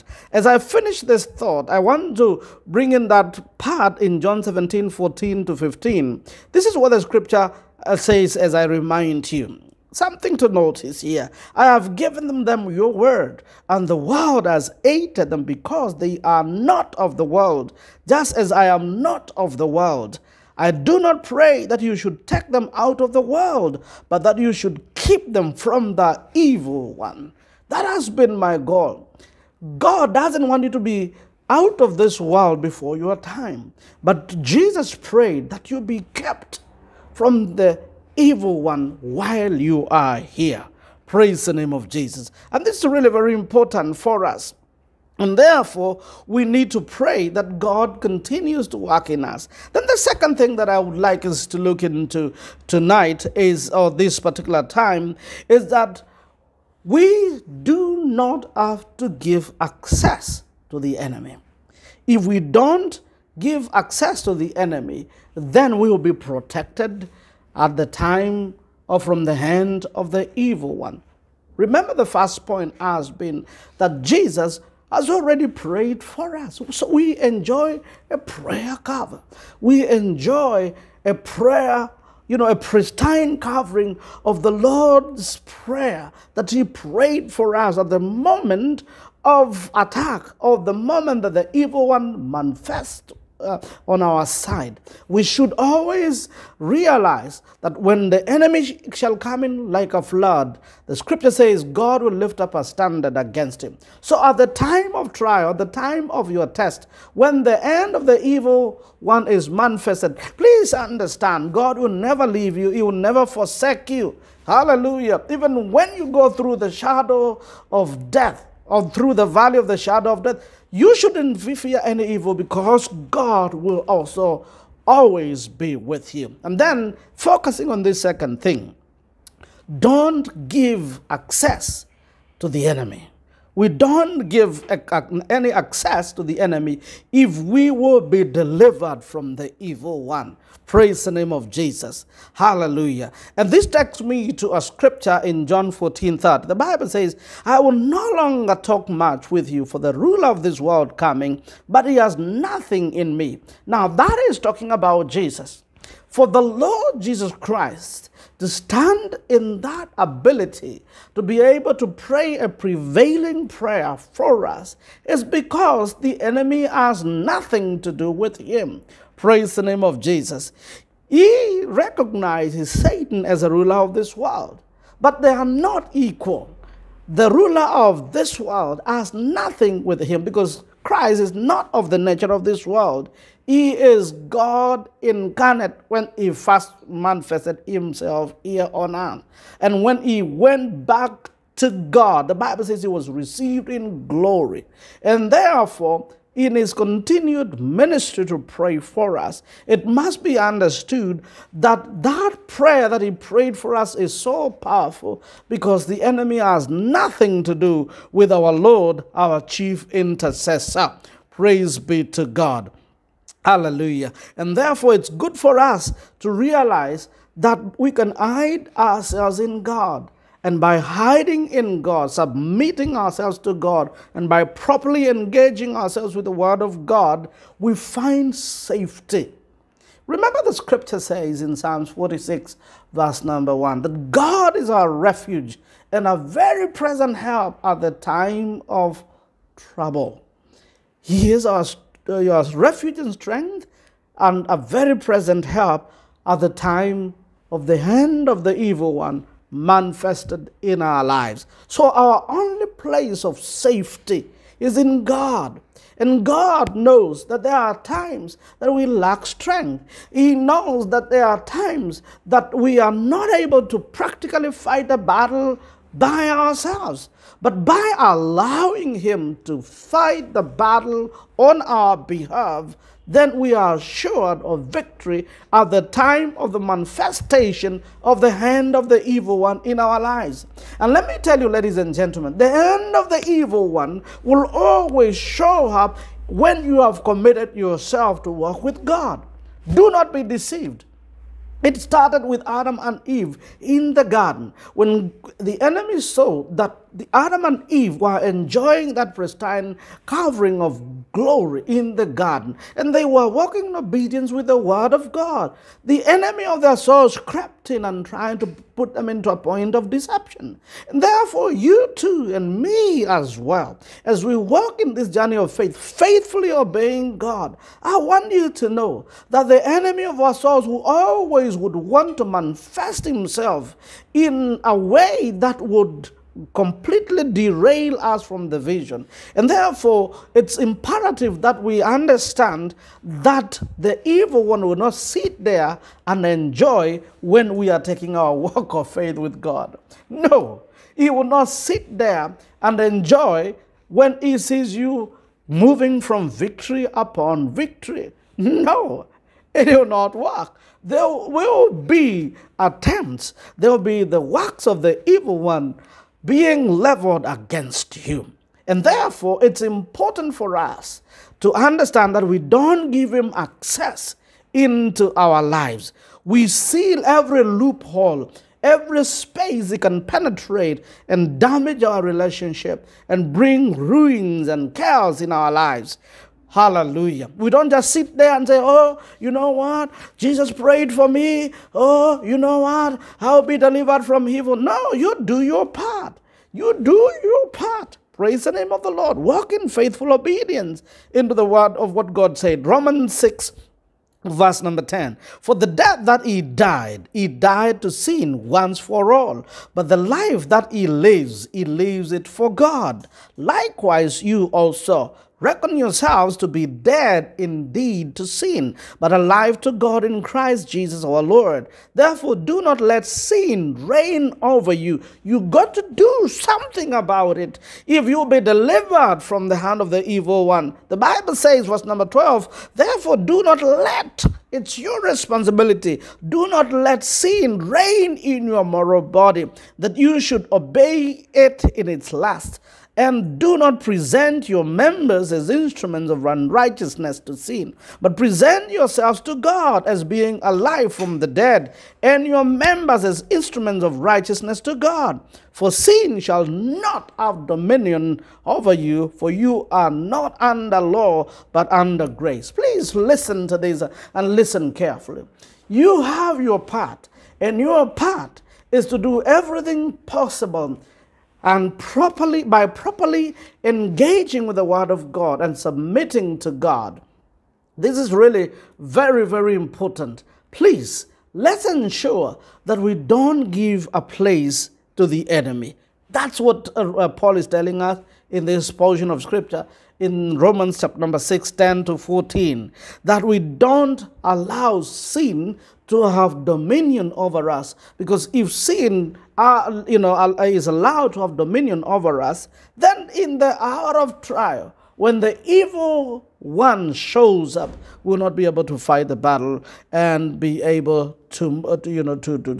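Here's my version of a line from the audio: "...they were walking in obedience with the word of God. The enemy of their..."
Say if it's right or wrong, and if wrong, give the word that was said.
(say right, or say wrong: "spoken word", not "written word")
right.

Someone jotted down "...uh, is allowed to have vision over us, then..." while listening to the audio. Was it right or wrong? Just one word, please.
wrong.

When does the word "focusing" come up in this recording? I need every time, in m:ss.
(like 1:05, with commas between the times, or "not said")
2:07.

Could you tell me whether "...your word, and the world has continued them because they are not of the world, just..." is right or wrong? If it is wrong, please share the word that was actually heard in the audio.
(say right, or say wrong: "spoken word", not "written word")
wrong: "hated", not "continued".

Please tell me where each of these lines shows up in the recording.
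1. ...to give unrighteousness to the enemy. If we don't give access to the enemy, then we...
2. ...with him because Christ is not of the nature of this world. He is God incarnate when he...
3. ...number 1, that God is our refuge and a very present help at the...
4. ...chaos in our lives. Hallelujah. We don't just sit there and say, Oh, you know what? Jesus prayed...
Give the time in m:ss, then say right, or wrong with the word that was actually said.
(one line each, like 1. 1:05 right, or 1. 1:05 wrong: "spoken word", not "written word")
1. 0:58 wrong: "access", not "unrighteousness"
2. 2:59 right
3. 3:53 right
4. 6:14 right.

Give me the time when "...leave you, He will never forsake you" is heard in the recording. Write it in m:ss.
1:52.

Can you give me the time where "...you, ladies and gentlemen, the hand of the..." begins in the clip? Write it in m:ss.
4:41.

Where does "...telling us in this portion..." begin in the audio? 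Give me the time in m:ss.
7:57.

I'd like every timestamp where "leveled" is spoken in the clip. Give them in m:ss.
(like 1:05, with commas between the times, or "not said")
5:56.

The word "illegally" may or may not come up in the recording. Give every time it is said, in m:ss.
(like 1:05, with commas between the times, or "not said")
not said.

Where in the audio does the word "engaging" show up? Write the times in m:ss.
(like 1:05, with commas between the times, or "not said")
3:45, 7:43.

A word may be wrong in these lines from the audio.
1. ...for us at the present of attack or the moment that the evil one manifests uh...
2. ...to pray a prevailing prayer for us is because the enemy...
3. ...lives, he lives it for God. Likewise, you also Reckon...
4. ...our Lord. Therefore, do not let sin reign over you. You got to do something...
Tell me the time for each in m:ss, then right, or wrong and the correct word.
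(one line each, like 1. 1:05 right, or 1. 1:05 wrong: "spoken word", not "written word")
1. 1:27 wrong: "moment", not "present"
2. 2:41 right
3. 6:40 right
4. 6:51 right.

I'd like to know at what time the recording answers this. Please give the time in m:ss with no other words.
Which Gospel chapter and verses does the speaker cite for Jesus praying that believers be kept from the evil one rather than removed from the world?
0:04.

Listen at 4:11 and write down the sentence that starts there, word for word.
So our only place of safety is in God.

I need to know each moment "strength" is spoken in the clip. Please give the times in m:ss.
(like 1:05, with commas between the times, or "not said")
4:03, 4:19.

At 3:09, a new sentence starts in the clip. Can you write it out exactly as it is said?
And when he went back to God, the Bible says he was received in glory.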